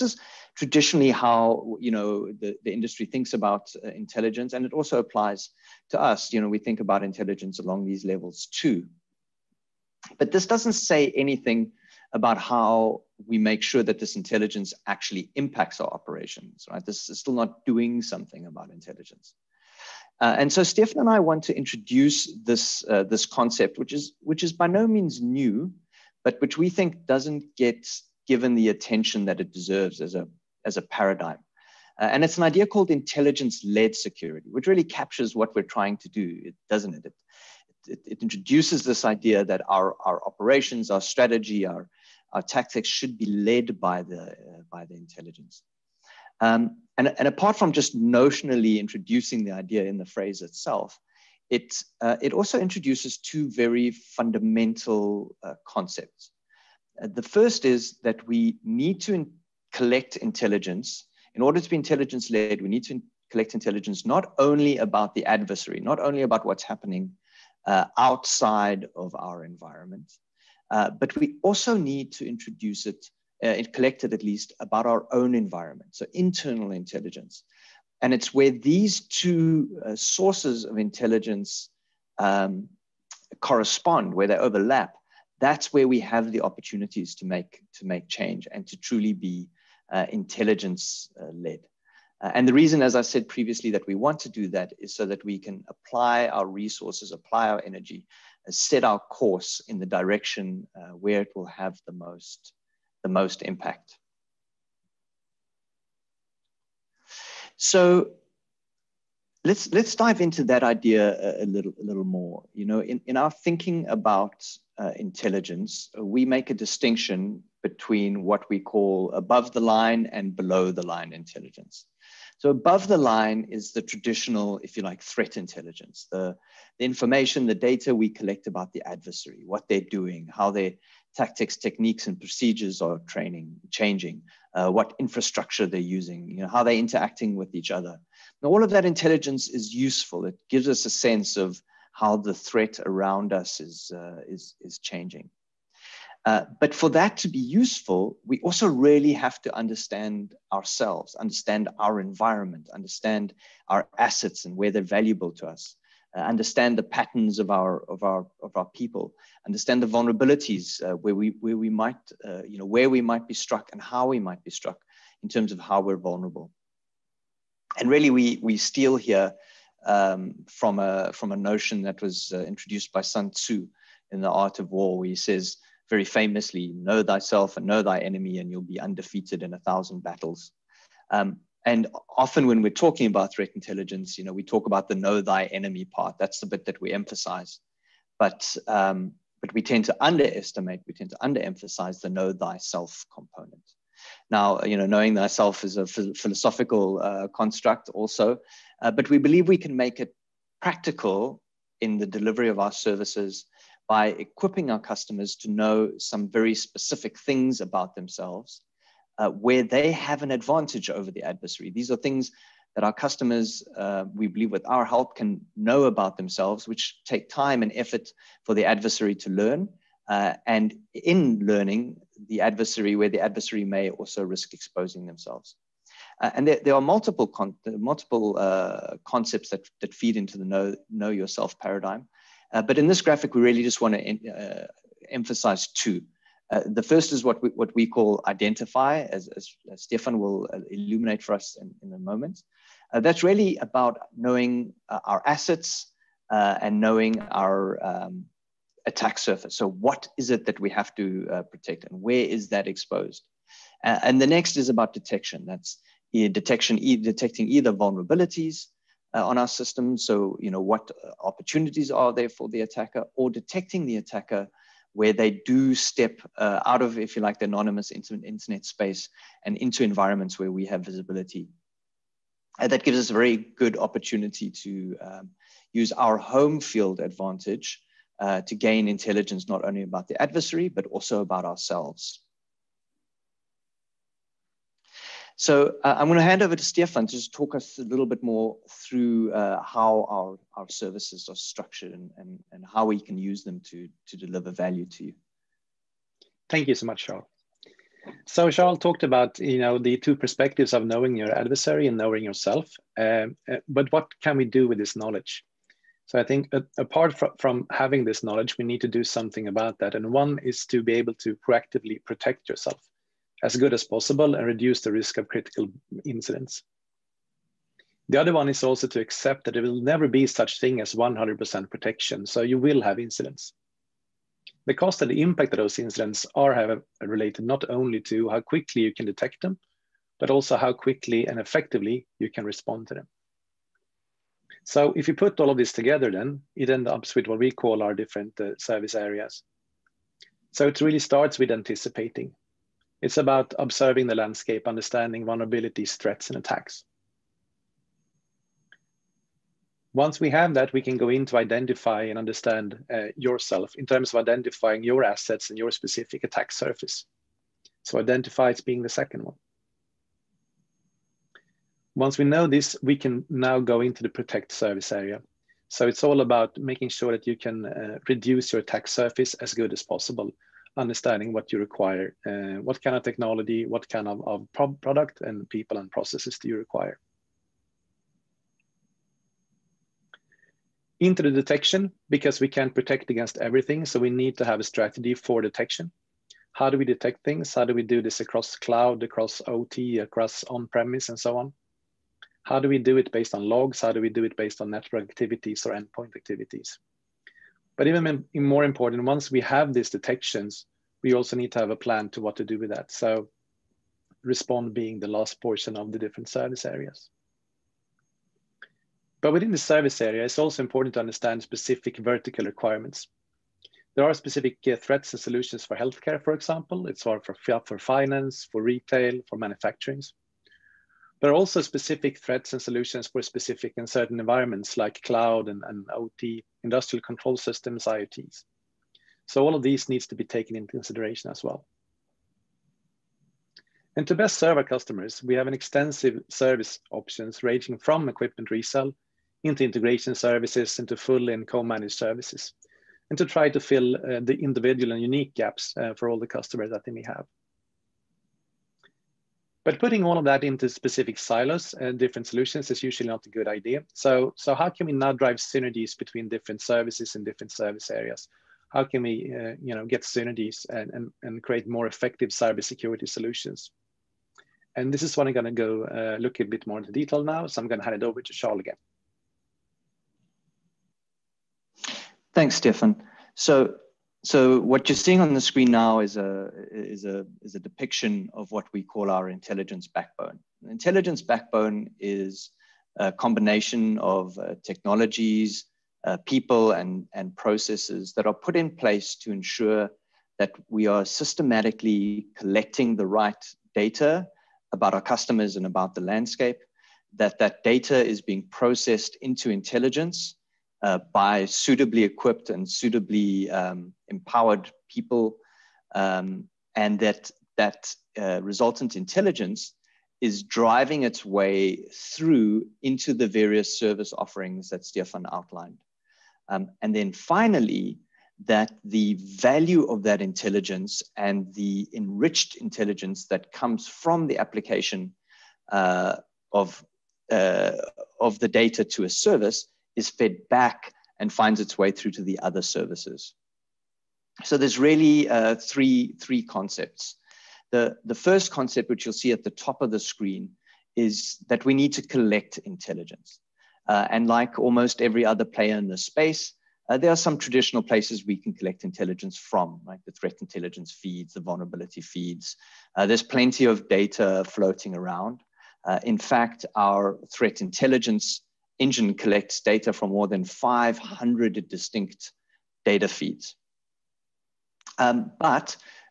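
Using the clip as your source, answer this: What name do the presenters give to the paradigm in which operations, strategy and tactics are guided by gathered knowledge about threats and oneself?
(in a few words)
Intelligence-led security.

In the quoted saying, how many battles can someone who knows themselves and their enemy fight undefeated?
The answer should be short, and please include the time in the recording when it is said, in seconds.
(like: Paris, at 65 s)
1000, at 179 s.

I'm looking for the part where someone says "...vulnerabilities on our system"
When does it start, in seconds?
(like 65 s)
257 s.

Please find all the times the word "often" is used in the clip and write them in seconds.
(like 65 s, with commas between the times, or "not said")
182 s.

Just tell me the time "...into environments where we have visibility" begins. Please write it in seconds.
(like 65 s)
269 s.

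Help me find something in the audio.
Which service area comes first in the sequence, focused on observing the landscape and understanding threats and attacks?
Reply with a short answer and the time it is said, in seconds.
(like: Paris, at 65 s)
Anticipating, at 341 s.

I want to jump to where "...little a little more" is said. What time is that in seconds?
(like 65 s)
111 s.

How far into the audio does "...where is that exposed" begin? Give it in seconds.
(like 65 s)
252 s.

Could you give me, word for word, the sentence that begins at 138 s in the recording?
Now, all of that intelligence is useful.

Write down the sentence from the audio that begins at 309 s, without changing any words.
And one is to be able to proactively protect yourself as good as possible and reduce the risk of critical incidents.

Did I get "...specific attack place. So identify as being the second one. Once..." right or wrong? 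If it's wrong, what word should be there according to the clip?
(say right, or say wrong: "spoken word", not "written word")
wrong: "surface", not "place".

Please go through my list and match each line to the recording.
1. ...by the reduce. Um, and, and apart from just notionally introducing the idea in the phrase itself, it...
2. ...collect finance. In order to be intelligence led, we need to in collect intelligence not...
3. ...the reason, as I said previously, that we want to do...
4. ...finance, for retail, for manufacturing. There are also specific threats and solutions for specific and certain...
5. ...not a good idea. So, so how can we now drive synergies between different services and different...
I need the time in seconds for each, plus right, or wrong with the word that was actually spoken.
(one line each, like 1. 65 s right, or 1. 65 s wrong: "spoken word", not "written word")
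1. 44 s wrong: "intelligence", not "reduce"
2. 59 s wrong: "intelligence", not "finance"
3. 92 s right
4. 417 s right
5. 453 s right.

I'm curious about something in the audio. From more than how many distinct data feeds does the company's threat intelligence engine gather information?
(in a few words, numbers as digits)
500.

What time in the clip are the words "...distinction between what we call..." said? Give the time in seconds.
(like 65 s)
116 s.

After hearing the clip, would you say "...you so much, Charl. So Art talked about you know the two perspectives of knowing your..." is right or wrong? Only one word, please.
wrong.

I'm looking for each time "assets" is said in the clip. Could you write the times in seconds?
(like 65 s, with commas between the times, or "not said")
153 s, 245 s, 355 s.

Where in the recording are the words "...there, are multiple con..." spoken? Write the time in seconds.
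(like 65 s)
226 s.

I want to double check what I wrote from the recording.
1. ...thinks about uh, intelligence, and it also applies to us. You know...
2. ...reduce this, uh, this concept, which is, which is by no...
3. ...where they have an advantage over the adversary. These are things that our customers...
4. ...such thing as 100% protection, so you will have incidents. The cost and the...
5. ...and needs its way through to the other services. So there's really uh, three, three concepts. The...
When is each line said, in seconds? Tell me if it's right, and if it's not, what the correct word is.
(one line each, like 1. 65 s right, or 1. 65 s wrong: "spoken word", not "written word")
1. 3 s right
2. 21 s wrong: "introduce", not "reduce"
3. 209 s right
4. 320 s right
5. 531 s wrong: "finds", not "needs".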